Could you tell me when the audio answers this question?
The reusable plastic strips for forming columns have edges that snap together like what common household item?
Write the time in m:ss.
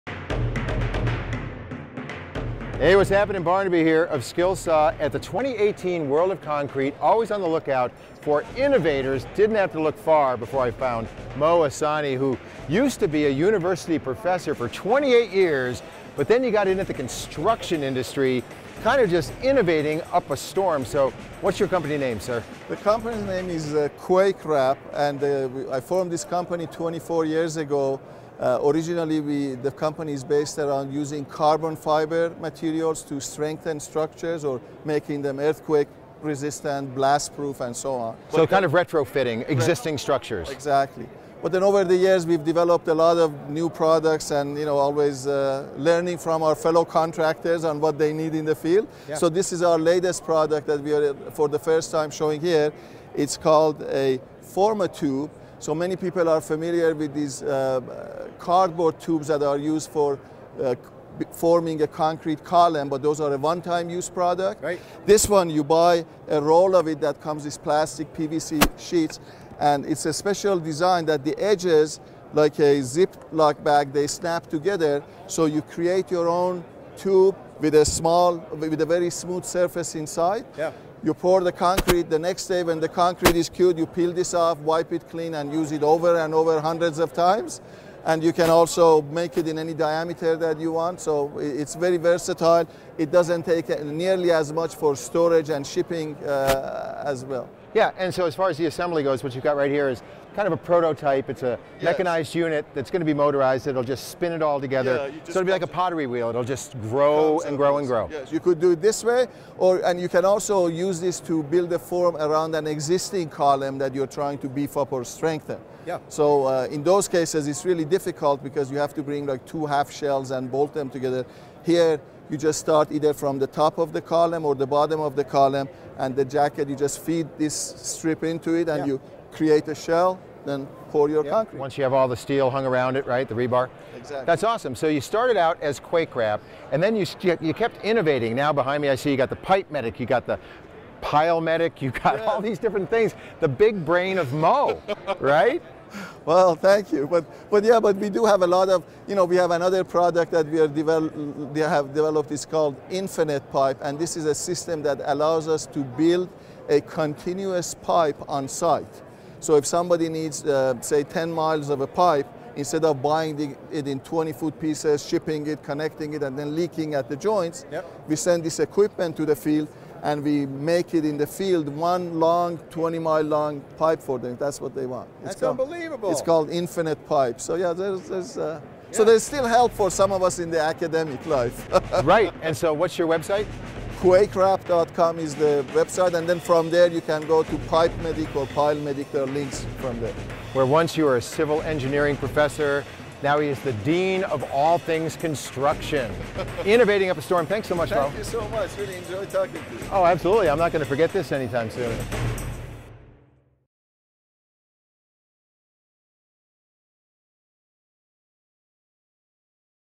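1:12.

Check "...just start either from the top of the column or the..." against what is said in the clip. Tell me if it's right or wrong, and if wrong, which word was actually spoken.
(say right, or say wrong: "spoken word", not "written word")
right.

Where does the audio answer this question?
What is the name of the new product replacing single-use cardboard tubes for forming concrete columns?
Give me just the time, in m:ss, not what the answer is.
0:54.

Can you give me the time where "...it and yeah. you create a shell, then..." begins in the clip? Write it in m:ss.
2:08.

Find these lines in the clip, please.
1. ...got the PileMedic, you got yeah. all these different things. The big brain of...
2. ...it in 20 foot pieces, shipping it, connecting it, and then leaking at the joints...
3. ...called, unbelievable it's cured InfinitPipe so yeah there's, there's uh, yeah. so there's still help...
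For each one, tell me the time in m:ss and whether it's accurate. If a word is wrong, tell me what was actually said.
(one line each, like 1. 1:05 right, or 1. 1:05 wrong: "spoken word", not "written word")
1. 2:20 right
2. 2:43 right
3. 2:55 wrong: "called", not "cured".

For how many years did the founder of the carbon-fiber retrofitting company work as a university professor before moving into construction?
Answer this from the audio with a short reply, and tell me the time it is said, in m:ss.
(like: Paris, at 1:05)
28, at 0:14.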